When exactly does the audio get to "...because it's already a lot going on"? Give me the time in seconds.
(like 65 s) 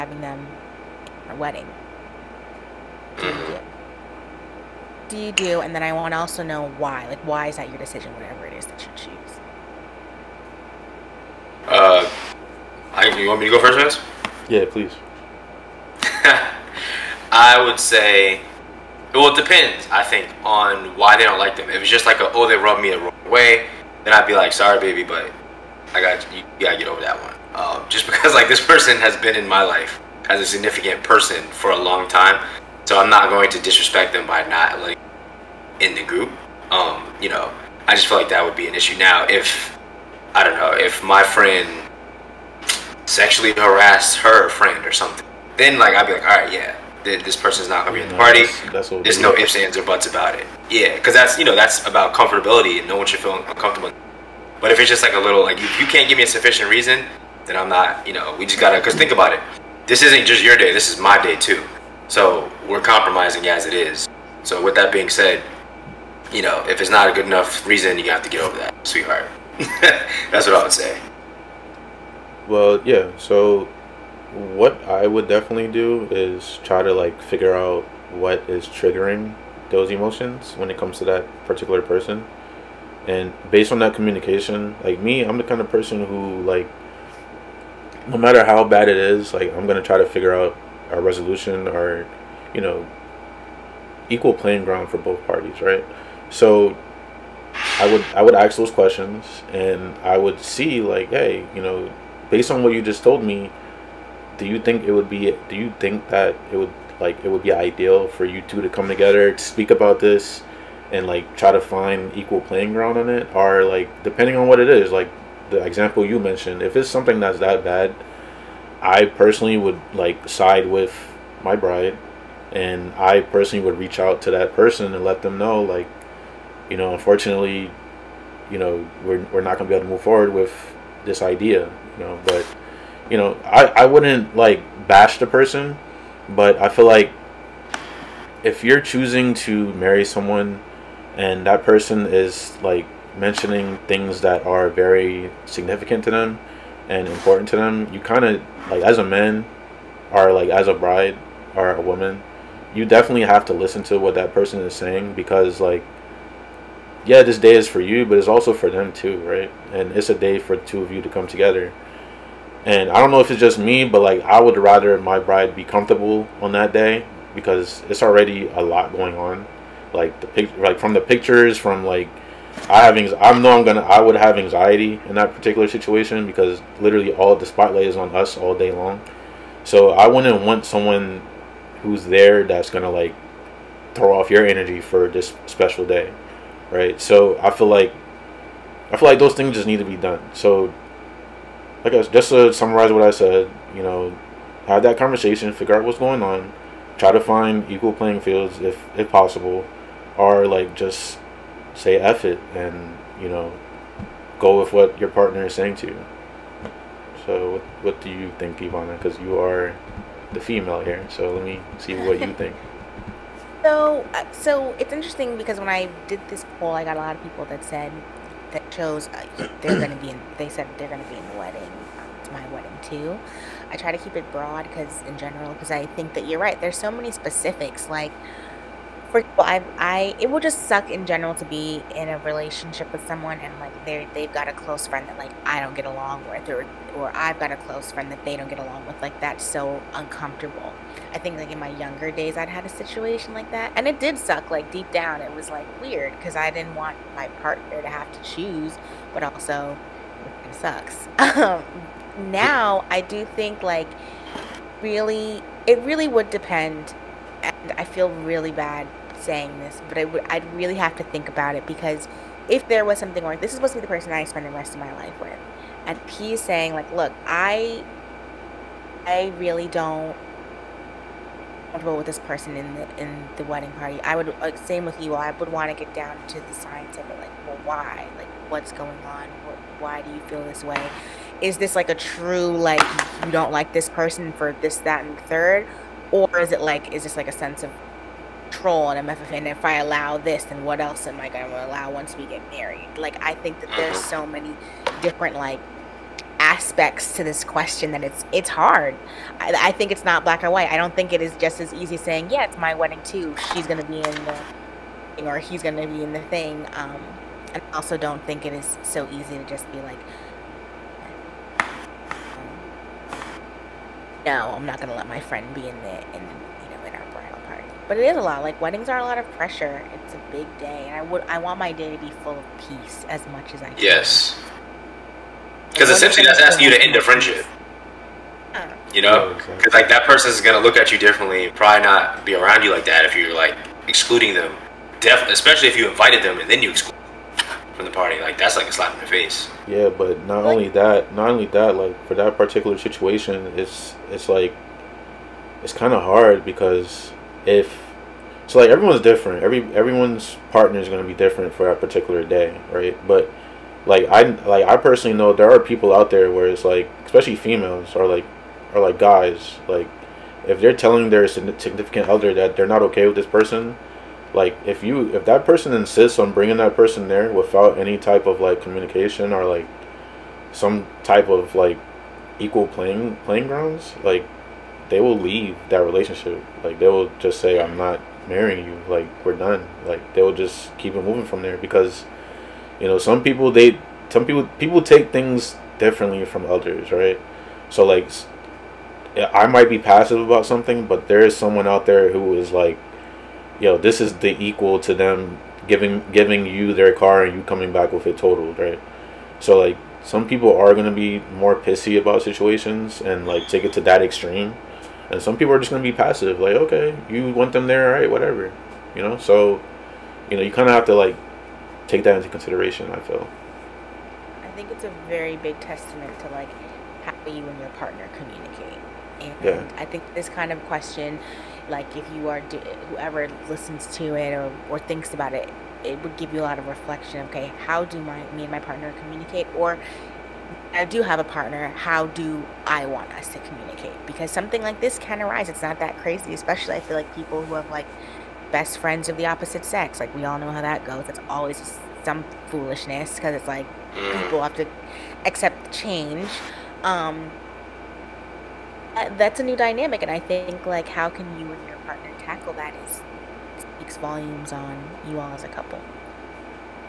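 167 s.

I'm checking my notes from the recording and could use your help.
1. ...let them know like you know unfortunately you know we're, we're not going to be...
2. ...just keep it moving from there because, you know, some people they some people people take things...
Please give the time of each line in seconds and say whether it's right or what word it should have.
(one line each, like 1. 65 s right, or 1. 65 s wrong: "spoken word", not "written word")
1. 125 s right
2. 380 s right.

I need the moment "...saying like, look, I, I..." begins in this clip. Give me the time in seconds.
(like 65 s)
266 s.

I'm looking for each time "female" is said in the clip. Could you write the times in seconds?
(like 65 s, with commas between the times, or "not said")
210 s, 357 s.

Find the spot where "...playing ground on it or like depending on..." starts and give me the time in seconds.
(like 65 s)
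112 s.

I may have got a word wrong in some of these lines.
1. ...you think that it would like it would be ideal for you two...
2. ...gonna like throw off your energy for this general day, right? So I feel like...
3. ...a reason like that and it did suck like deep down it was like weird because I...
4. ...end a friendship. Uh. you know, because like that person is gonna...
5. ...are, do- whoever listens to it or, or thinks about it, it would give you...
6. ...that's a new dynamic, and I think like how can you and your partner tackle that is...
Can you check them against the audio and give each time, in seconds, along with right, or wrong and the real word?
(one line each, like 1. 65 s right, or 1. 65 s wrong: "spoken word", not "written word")
1. 105 s right
2. 182 s wrong: "special", not "general"
3. 242 s wrong: "situation", not "reason"
4. 326 s right
5. 422 s right
6. 449 s right.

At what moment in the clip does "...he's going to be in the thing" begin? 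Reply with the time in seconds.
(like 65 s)
305 s.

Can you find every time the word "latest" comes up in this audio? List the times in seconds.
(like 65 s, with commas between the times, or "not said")
not said.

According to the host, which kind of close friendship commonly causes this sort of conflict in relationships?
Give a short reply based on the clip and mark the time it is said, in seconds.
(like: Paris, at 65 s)
Best friends of the opposite sex, at 438 s.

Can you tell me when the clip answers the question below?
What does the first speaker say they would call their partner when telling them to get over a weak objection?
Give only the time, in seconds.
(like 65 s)
68 s.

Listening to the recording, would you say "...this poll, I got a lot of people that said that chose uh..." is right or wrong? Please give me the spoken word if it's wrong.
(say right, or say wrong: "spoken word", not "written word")
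right.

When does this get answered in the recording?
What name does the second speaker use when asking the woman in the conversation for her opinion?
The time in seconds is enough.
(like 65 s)
208 s.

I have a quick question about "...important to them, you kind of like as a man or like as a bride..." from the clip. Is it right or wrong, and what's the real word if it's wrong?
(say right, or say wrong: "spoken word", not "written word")
right.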